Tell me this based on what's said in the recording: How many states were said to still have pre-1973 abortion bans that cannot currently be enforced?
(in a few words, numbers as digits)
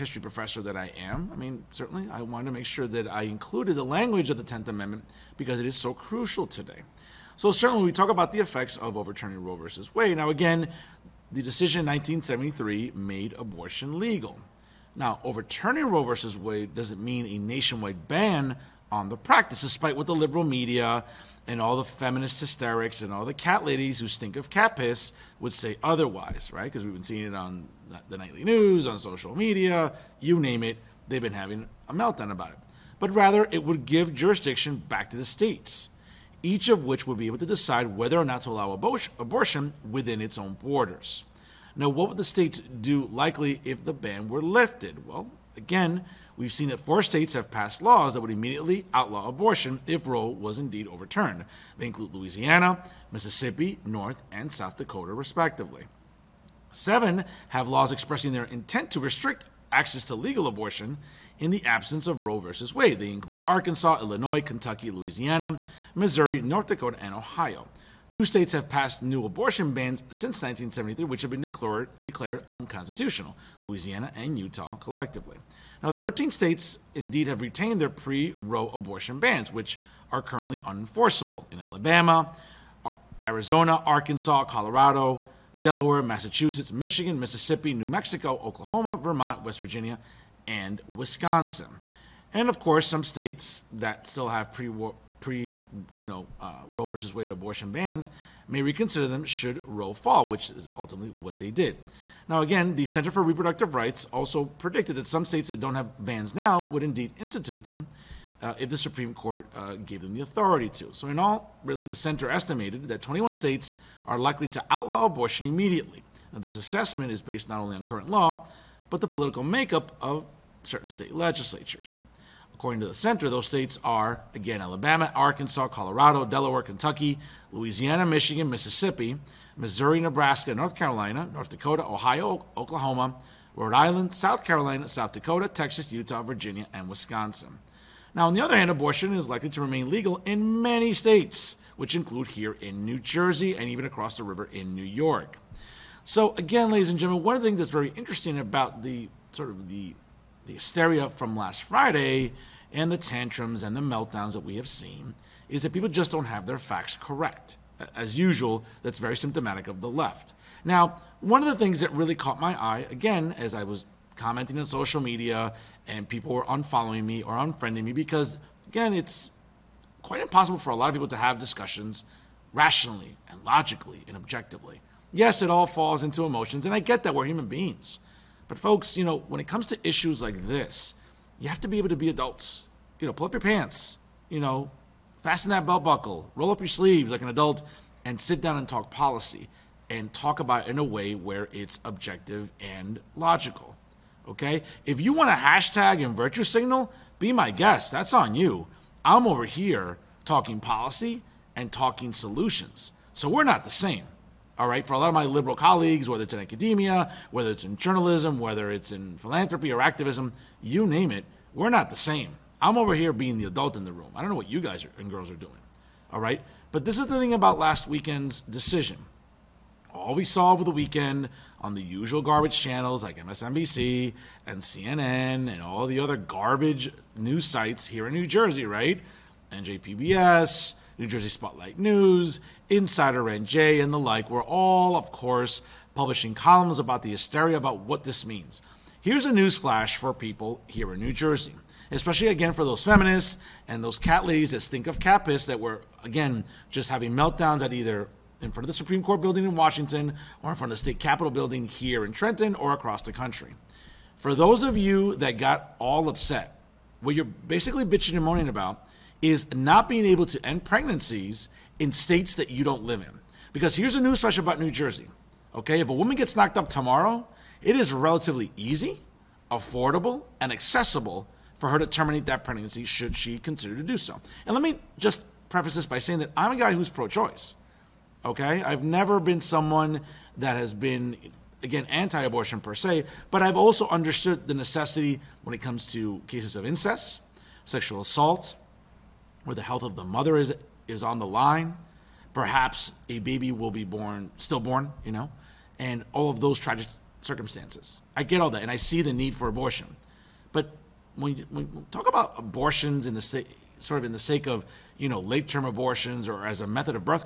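13.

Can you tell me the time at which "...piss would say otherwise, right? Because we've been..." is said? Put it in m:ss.
0:24.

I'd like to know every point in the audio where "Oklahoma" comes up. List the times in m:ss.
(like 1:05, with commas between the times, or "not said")
1:28, 2:12.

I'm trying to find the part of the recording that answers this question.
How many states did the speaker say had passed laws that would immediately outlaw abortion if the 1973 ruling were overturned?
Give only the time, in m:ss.
0:46.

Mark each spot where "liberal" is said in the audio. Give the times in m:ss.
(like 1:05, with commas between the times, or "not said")
0:20, 3:25.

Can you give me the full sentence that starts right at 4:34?
And let me just preface this by saying that I'm a guy who's pro-choice.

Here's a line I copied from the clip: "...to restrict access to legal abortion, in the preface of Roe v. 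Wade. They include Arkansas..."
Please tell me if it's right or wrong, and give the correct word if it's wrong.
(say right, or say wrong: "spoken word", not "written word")
wrong: "absence", not "preface".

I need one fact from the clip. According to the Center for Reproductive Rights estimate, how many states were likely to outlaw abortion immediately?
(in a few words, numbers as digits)
21.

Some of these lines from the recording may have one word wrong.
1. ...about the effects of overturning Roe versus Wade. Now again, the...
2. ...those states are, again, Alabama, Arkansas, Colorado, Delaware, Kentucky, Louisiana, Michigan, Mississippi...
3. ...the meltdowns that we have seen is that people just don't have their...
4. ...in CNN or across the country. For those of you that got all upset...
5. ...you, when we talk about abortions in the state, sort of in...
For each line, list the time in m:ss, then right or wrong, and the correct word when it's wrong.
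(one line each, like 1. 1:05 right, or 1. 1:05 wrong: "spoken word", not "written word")
1. 0:08 right
2. 2:03 right
3. 2:33 right
4. 4:12 wrong: "Trenton", not "CNN"
5. 5:01 right.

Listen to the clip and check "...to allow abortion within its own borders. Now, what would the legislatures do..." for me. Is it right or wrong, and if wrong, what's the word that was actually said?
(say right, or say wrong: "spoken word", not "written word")
wrong: "states", not "legislatures".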